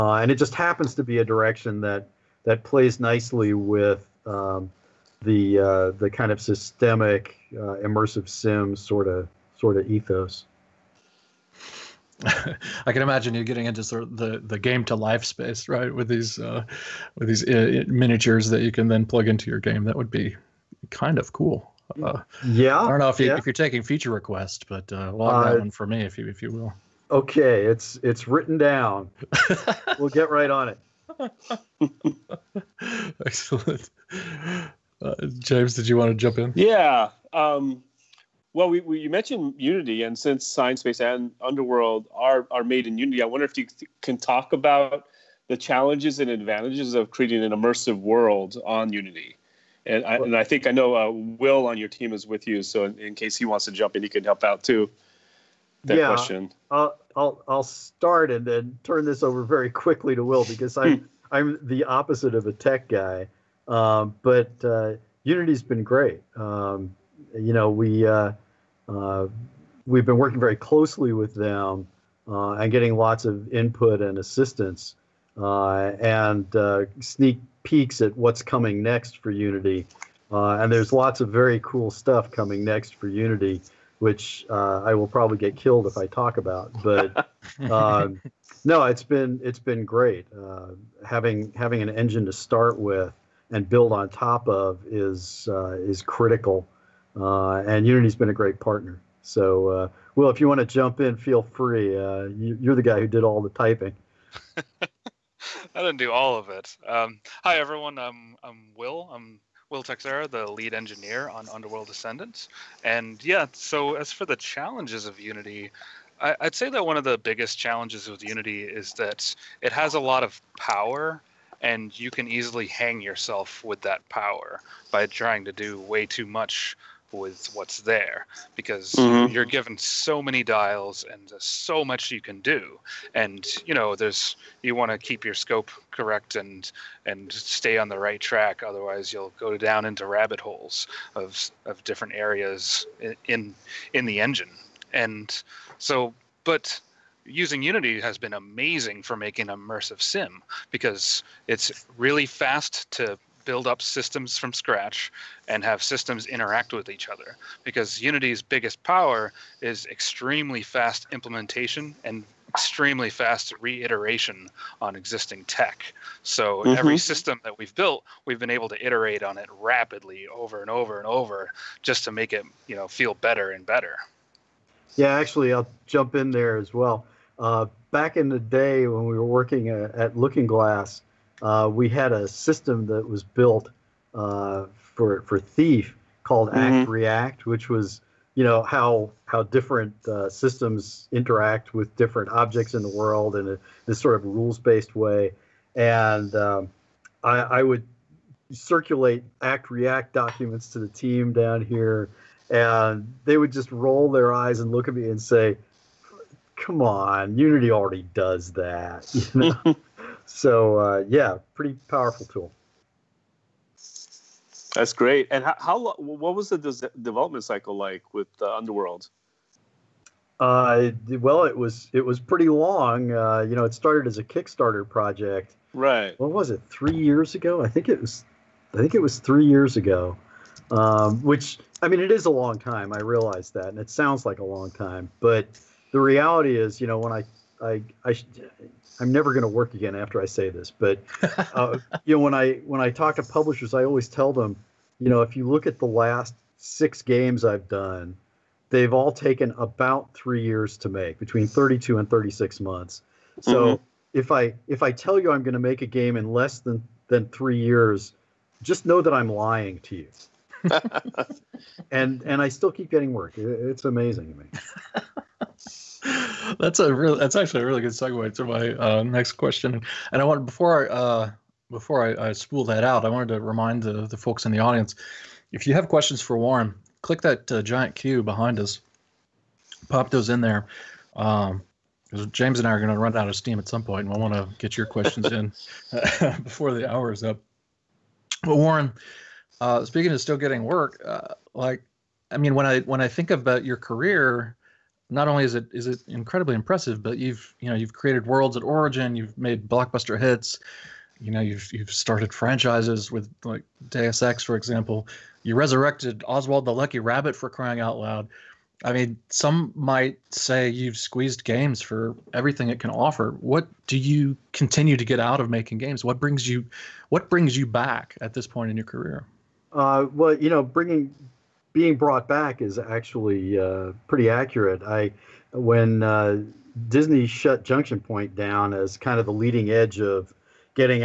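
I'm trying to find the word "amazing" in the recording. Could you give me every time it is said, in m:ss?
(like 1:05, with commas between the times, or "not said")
2:28, 4:23.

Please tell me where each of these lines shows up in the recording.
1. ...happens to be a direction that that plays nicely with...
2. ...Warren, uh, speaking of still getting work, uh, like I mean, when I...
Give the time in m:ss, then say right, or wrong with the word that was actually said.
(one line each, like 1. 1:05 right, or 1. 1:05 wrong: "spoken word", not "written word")
1. 0:00 right
2. 4:48 right.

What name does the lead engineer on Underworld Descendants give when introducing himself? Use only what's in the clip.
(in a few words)
Will Texera.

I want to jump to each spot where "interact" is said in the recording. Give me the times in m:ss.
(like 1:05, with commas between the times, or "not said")
2:36, 3:11.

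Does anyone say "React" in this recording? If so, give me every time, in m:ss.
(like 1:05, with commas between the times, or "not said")
3:06, 3:19.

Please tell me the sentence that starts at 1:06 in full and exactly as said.
Um, you know we uh, uh, we've been working very closely with them uh, and getting lots of input and assistance.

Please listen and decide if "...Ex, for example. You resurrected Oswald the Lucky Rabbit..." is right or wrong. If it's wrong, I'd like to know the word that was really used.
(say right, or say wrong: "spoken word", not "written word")
right.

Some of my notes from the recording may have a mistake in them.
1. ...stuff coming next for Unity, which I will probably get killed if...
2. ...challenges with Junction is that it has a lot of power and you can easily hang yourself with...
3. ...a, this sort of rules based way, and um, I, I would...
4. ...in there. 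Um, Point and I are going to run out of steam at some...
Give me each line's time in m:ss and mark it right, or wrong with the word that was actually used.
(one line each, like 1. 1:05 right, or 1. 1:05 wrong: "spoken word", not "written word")
1. 1:21 right
2. 1:57 wrong: "Unity", not "Junction"
3. 3:13 right
4. 4:40 wrong: "James", not "Point".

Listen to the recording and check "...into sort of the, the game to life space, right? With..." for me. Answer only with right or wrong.
right.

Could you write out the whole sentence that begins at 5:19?
Uh, well, you know, bringing being brought back is actually uh, pretty accurate.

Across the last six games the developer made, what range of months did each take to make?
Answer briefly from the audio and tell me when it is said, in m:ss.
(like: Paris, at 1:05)
32 to 36 months, at 4:11.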